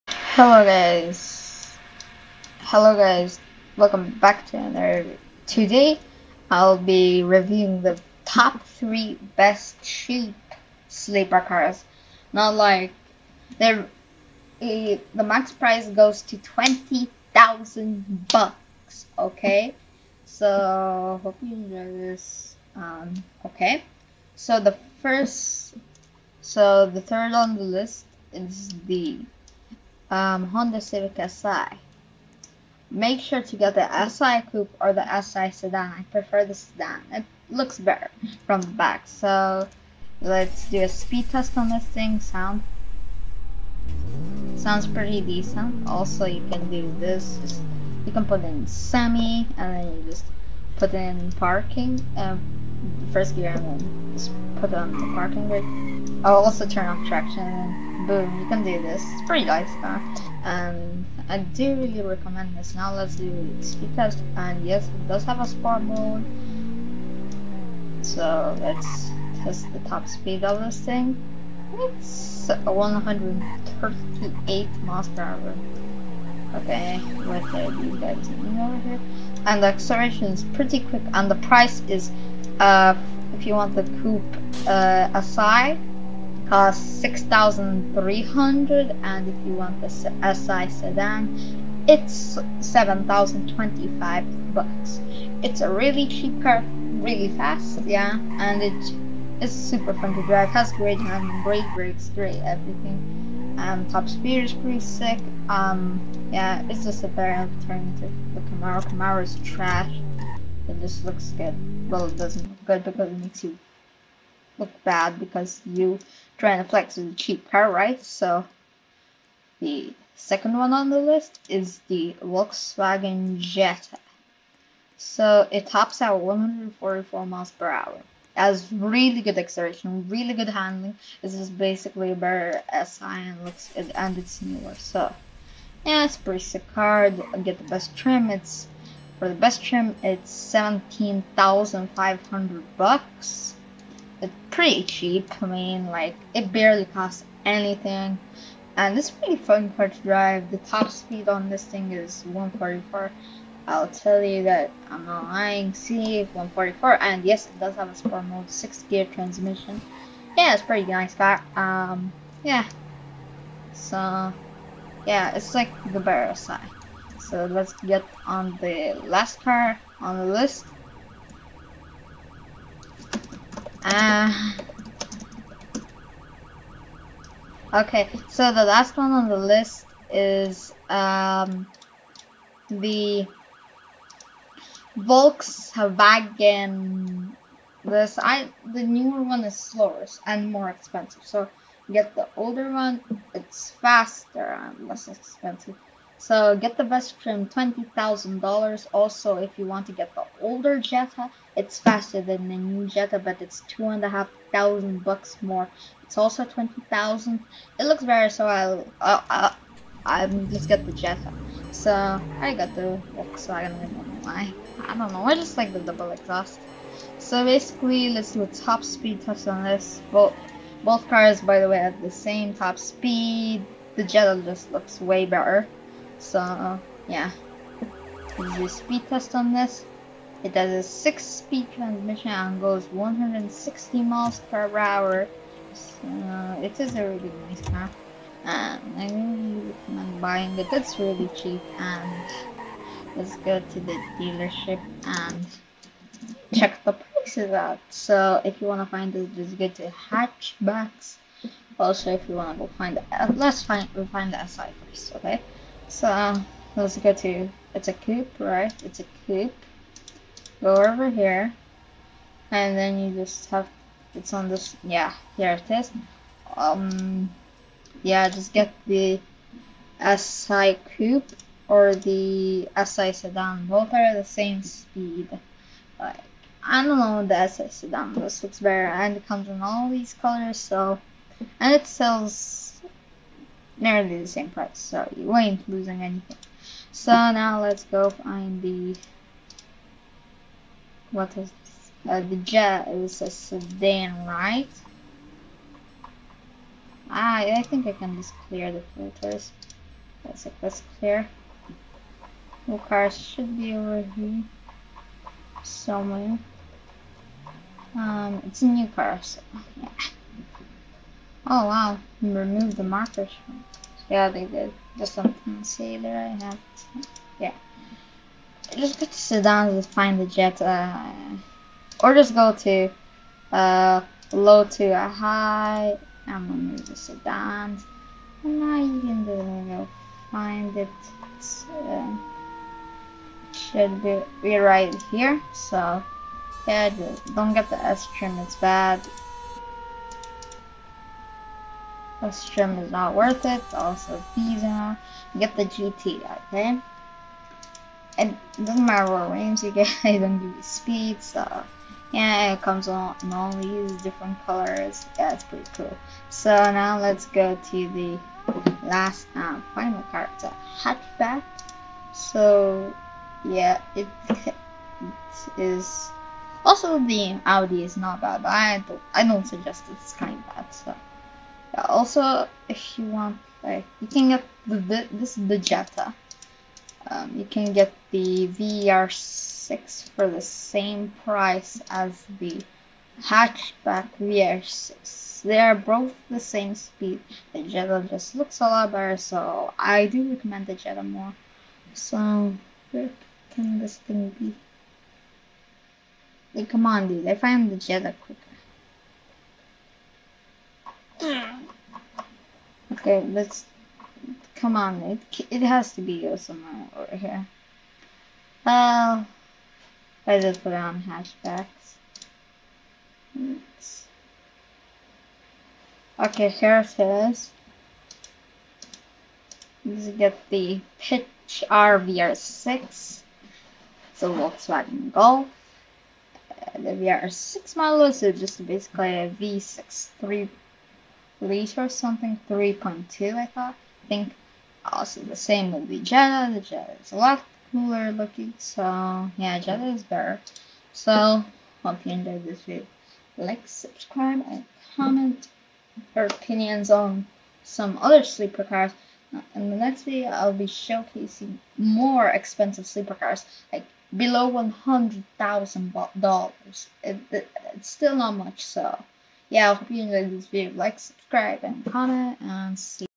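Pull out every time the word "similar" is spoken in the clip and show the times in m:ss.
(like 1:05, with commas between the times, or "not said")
not said.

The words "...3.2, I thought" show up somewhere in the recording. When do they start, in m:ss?
7:12.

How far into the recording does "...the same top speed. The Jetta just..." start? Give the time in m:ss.
3:42.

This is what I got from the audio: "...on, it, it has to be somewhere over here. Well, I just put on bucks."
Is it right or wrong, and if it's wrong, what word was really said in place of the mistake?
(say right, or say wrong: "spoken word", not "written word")
wrong: "hatchbacks", not "bucks".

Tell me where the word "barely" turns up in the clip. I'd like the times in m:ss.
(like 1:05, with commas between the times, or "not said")
2:26.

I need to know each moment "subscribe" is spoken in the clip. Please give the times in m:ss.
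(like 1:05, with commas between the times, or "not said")
7:23, 7:40.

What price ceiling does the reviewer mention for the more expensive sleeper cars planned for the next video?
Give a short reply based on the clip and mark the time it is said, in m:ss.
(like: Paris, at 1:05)
$100,000, at 7:34.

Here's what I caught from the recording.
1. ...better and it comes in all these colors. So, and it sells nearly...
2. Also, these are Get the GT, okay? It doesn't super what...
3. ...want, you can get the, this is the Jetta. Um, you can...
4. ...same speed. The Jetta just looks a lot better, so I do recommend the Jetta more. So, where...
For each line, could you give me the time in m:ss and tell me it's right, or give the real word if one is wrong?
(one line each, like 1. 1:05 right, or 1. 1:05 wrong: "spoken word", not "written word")
1. 4:38 right
2. 5:43 wrong: "matter", not "super"
3. 6:13 right
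4. 6:26 right.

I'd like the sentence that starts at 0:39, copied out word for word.
So let's do a speed test on this thing.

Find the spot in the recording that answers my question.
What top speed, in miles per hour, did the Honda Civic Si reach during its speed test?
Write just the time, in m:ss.
1:12.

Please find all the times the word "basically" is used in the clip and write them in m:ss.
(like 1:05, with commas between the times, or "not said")
2:11, 3:37, 7:08.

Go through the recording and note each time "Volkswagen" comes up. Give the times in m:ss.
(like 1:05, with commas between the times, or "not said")
2:02, 3:04, 3:33, 7:04.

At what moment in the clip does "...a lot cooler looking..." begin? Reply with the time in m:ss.
7:17.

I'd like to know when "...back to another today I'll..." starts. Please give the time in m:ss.
0:04.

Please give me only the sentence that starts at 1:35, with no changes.
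It's a really cheap car, really fast, yeah, and it is super fun to drive, has great handling, great brakes, great everything.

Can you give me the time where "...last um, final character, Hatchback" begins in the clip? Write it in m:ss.
5:58.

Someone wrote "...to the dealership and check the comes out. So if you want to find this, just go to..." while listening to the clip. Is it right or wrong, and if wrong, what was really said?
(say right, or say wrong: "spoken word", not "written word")
wrong: "prices", not "comes".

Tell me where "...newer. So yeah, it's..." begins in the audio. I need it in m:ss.
2:14.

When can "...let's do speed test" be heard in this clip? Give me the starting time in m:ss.
1:02.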